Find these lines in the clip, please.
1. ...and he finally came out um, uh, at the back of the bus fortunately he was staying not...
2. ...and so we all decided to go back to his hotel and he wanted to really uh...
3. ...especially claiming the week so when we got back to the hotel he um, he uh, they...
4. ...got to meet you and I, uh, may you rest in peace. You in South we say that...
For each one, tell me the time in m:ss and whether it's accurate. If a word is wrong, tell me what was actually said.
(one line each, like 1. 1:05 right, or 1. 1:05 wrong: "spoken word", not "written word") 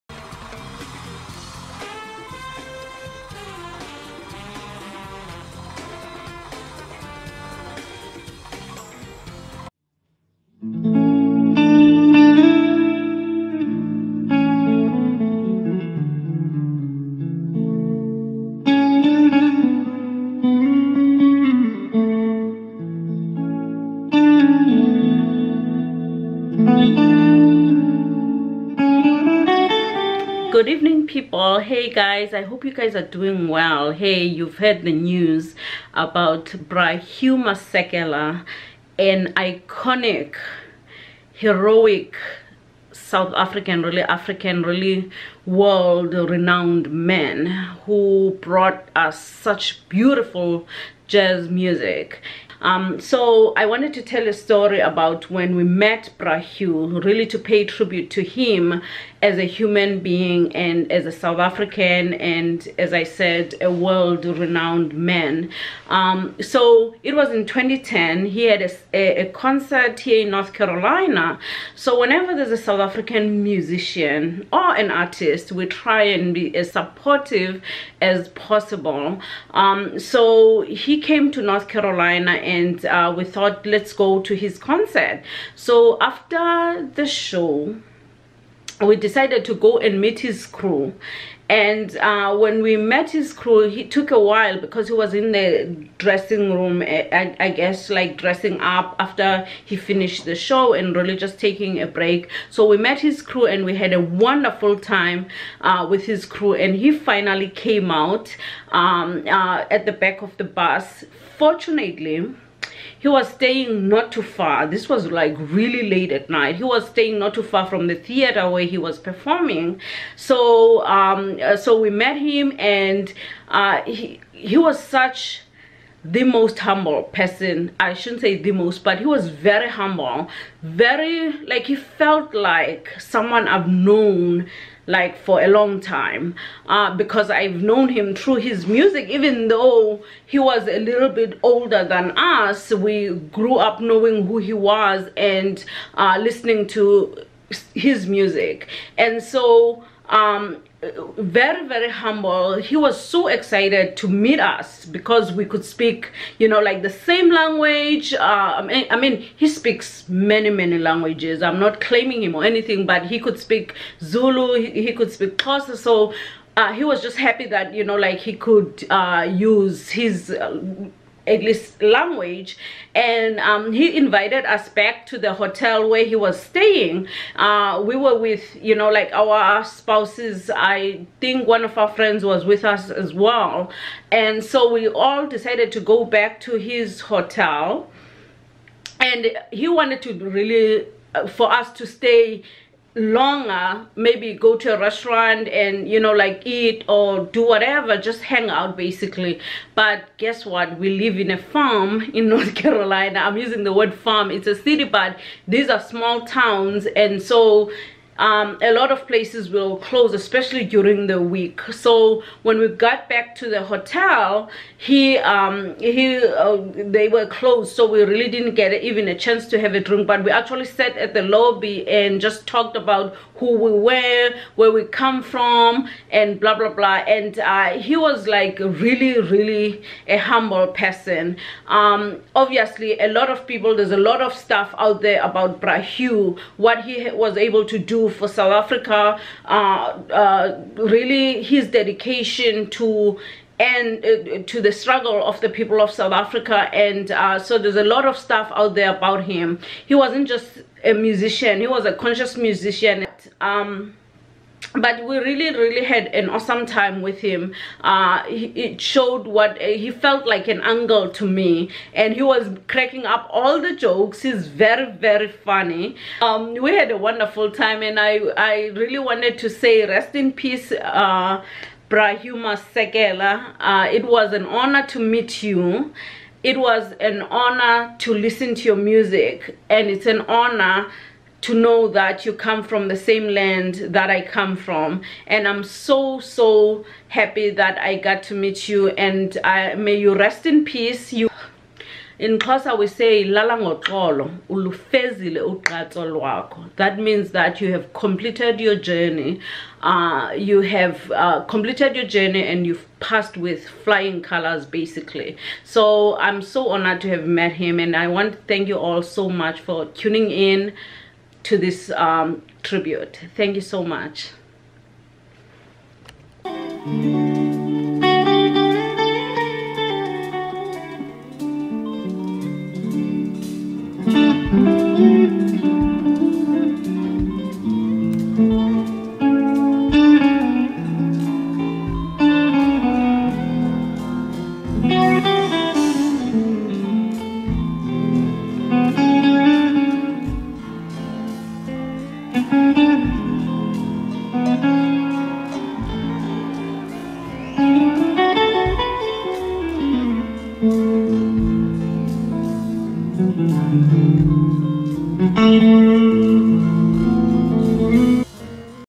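1. 1:46 right
2. 3:04 right
3. 3:30 wrong: "during", not "claiming"
4. 4:47 wrong: "Xhosa", not "South".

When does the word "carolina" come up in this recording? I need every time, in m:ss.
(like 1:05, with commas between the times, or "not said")
1:10, 1:21, 3:22.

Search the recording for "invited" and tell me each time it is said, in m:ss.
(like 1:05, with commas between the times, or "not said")
2:53.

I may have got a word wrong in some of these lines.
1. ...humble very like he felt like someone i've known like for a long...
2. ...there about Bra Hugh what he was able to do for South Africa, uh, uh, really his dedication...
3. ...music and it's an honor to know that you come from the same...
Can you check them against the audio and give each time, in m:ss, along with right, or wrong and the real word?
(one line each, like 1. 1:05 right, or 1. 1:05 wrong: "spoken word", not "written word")
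1. 2:09 right
2. 3:55 right
3. 4:38 right.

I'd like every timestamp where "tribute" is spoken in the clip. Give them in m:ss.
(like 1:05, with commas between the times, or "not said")
0:57, 5:12.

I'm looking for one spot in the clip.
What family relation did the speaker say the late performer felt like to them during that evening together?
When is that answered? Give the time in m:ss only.
4:20.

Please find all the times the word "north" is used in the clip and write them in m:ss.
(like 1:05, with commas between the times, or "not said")
1:10, 1:21, 3:22.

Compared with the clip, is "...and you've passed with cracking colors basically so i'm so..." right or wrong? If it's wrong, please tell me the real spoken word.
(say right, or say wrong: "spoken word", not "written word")
wrong: "flying", not "cracking".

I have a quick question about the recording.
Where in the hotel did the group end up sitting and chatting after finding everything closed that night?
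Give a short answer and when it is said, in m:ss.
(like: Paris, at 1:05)
the lobby, at 3:41.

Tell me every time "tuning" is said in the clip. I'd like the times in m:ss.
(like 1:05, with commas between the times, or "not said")
5:09.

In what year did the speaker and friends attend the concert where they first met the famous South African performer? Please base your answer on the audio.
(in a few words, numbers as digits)
2010.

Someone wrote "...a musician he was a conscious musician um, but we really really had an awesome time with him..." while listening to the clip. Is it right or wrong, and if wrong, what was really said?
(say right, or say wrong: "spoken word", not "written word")
right.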